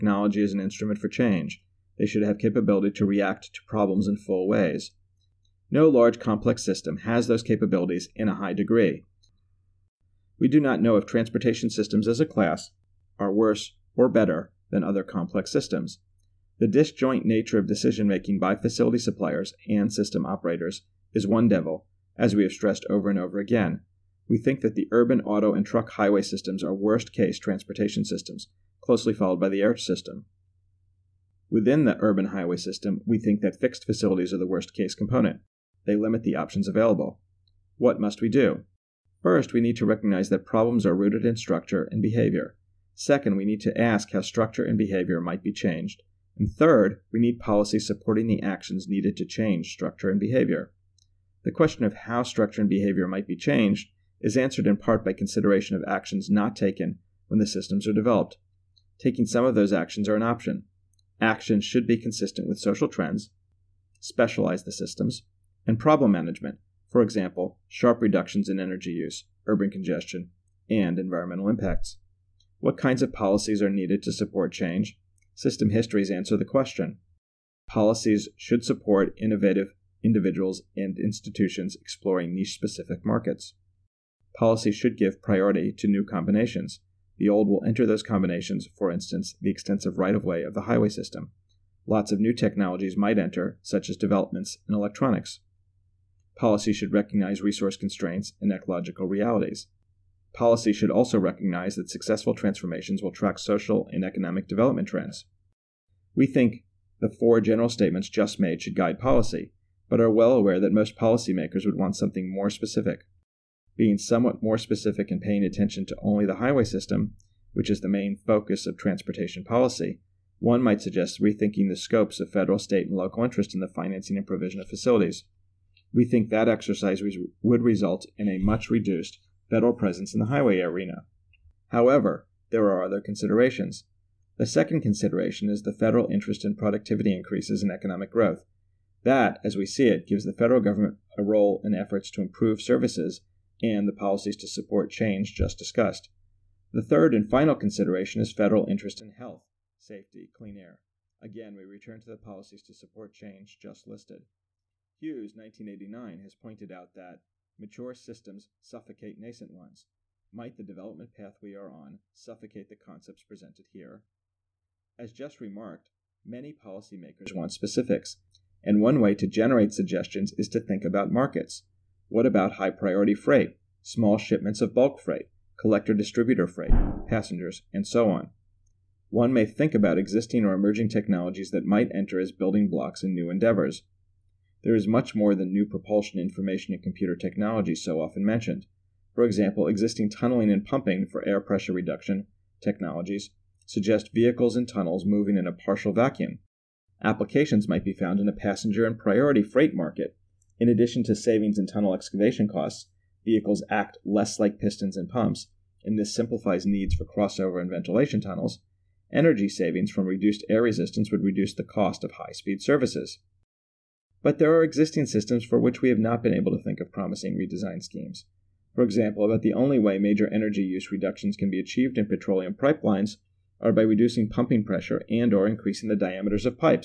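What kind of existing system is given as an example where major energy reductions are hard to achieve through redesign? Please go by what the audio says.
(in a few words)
petroleum pipelines.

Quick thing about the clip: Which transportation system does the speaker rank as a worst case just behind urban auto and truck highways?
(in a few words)
the air system.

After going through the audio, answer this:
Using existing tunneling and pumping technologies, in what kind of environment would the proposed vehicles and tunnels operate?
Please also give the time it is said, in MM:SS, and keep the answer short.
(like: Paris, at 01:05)
a partial vacuum, at 03:15.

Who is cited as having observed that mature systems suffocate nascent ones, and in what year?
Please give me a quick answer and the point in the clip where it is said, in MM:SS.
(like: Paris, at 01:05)
Hughes, 1989, at 02:34.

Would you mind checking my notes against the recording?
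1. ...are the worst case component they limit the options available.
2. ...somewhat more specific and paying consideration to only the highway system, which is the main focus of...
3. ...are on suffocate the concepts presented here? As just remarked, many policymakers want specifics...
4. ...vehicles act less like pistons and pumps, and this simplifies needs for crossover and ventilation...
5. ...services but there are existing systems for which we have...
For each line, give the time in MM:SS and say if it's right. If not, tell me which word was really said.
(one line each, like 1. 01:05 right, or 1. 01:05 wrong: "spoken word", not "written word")
1. 00:34 right
2. 01:53 wrong: "attention", not "consideration"
3. 02:41 right
4. 03:23 right
5. 03:32 right.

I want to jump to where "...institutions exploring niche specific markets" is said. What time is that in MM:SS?
01:20.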